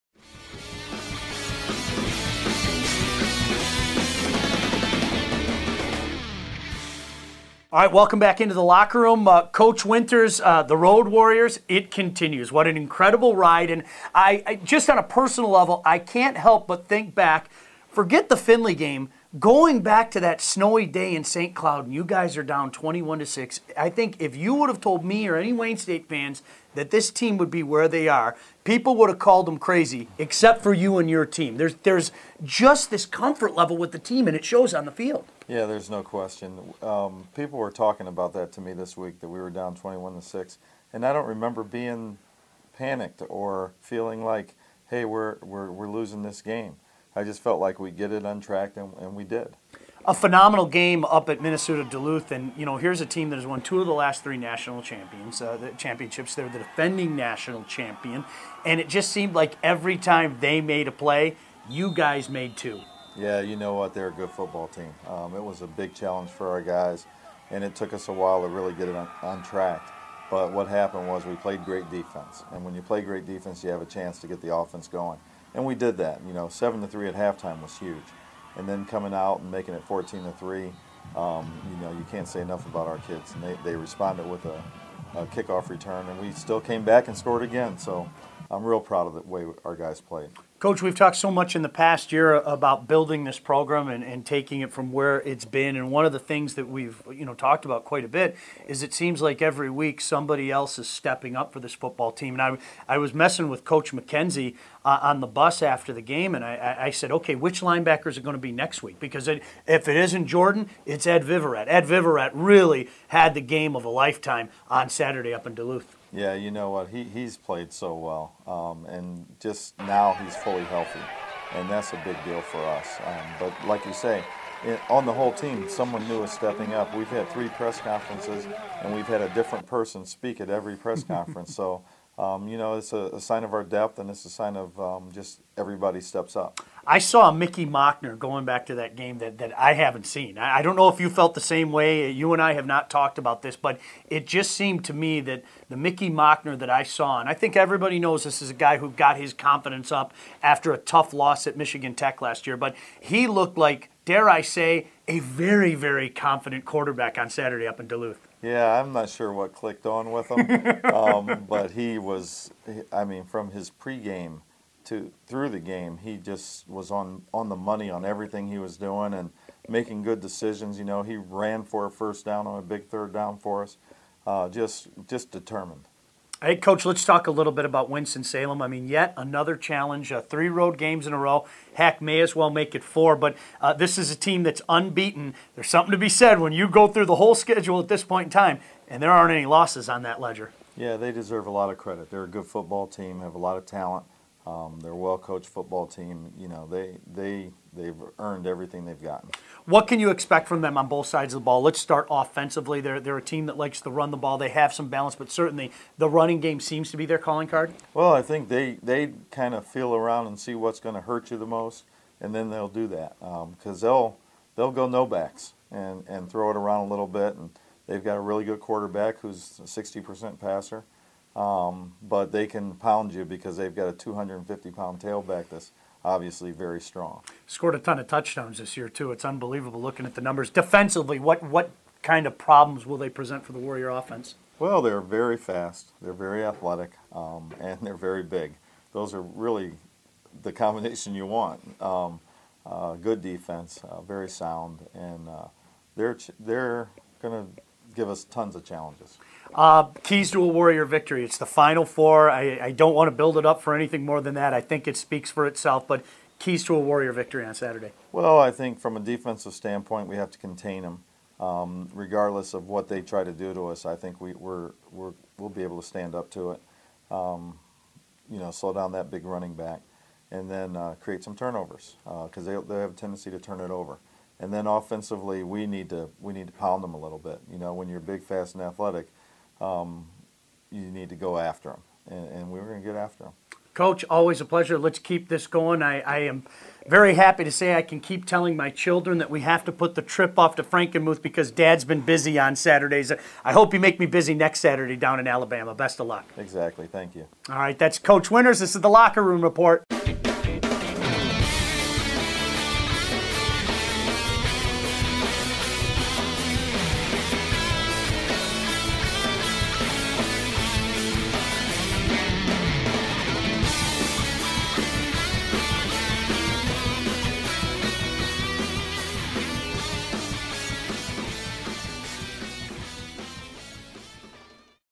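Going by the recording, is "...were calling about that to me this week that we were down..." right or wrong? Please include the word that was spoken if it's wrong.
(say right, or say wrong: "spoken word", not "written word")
wrong: "talking", not "calling".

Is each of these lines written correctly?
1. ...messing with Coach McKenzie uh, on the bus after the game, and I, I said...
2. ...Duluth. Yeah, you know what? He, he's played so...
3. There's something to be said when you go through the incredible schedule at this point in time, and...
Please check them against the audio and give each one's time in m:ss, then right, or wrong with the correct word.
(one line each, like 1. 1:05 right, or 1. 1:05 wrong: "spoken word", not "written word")
1. 1:43 right
2. 1:55 right
3. 3:05 wrong: "whole", not "incredible".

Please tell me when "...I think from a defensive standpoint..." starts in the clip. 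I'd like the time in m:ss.
4:18.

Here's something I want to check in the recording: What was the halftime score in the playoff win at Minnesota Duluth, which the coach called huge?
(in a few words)
7 to 3.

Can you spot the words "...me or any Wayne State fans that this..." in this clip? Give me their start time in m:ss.
0:25.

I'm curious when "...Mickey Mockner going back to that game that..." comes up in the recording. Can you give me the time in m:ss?
2:17.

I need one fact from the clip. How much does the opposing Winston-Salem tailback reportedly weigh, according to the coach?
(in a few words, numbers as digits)
250 pounds.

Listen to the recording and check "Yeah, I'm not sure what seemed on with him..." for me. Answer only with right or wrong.
wrong.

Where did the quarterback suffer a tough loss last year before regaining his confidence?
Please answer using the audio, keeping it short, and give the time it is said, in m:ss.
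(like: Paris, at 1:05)
Michigan Tech, at 2:31.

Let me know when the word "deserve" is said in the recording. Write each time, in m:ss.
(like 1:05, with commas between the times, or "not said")
3:11.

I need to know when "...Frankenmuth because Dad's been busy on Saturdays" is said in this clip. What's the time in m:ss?
4:50.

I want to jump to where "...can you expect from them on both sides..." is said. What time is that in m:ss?
3:19.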